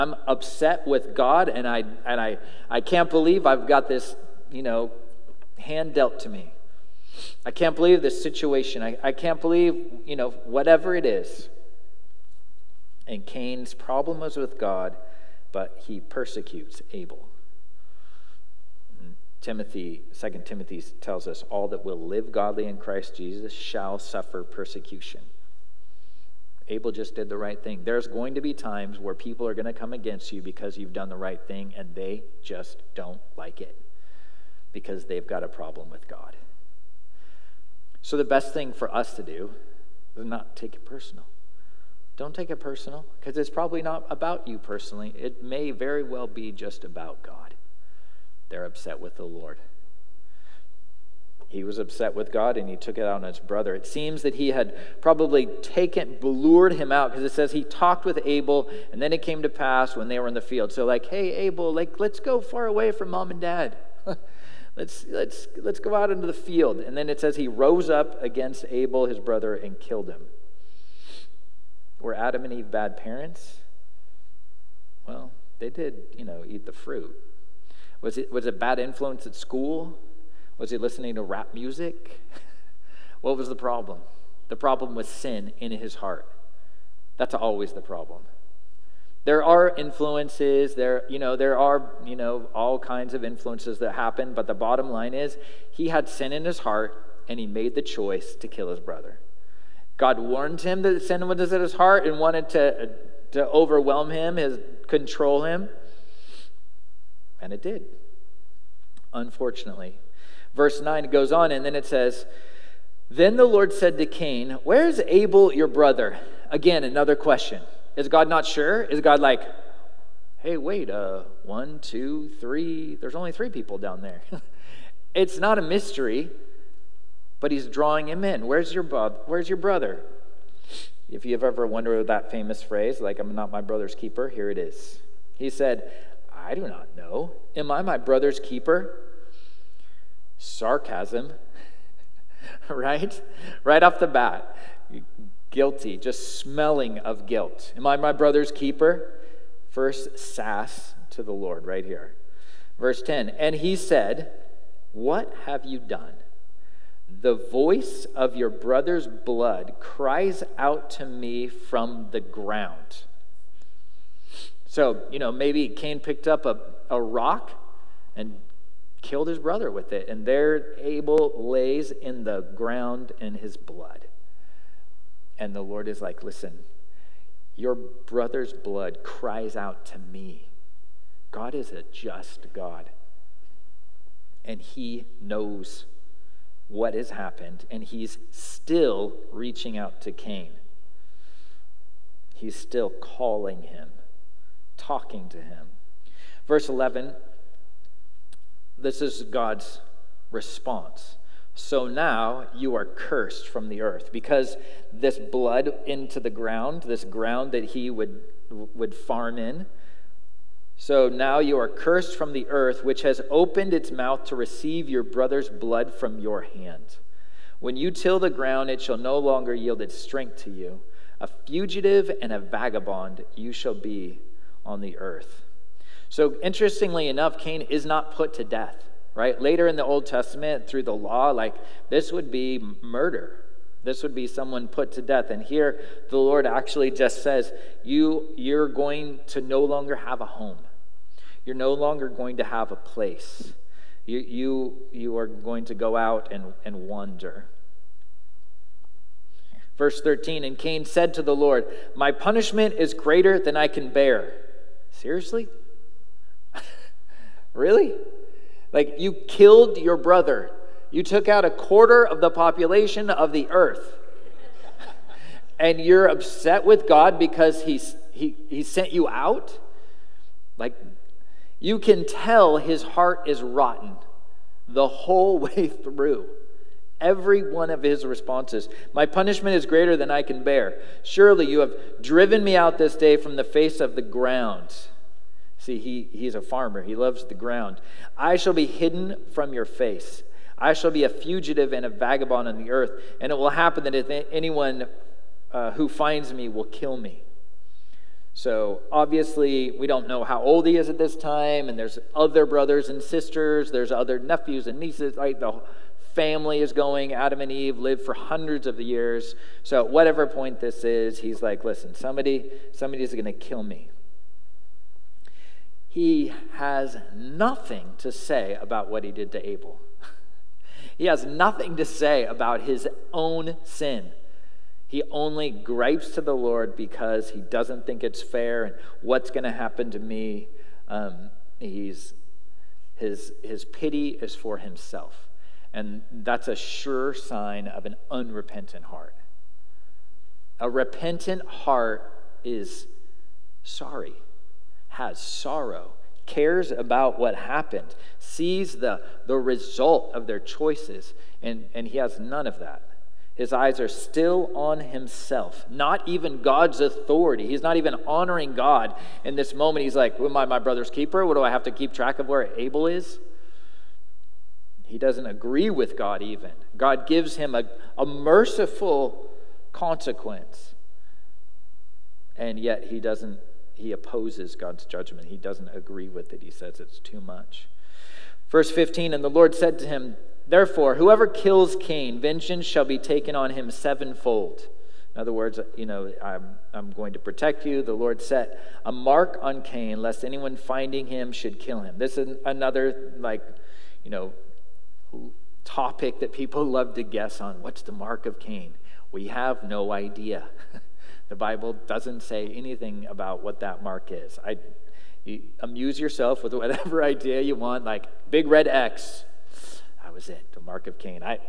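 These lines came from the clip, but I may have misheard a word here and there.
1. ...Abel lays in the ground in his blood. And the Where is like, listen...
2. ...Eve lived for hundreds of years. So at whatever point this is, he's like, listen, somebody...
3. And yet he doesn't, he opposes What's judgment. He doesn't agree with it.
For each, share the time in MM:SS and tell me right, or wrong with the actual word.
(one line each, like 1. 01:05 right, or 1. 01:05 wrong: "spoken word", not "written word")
1. 02:50 wrong: "Lord", not "Where"
2. 05:07 right
3. 06:12 wrong: "God", not "What".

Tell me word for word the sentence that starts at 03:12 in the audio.
He's still calling him talking to him.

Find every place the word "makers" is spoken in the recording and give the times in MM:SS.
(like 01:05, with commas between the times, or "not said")
not said.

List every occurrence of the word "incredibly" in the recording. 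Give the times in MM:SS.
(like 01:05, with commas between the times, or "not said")
not said.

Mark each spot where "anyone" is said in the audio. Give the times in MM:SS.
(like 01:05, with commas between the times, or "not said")
04:54, 06:30.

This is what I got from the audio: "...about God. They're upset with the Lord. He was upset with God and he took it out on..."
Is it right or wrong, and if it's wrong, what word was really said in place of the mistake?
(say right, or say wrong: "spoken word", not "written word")
right.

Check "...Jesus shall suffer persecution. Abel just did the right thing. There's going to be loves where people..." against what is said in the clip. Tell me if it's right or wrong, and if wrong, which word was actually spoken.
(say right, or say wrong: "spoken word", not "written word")
wrong: "times", not "loves".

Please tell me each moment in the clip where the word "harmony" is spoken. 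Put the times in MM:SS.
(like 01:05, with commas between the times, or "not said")
not said.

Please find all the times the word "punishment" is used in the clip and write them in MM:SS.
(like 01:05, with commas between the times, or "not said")
04:12, 04:39.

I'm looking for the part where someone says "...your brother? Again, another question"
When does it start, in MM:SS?
01:55.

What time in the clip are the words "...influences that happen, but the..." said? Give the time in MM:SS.
01:33.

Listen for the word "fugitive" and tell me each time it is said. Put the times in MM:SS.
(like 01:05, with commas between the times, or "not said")
03:41, 04:51.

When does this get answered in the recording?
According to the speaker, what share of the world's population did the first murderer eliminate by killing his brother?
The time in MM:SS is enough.
04:21.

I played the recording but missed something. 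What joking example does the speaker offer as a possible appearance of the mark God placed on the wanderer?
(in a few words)
Big red X.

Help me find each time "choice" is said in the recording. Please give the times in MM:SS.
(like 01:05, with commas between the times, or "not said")
01:37, 05:50.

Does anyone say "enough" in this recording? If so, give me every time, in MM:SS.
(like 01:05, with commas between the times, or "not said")
03:47.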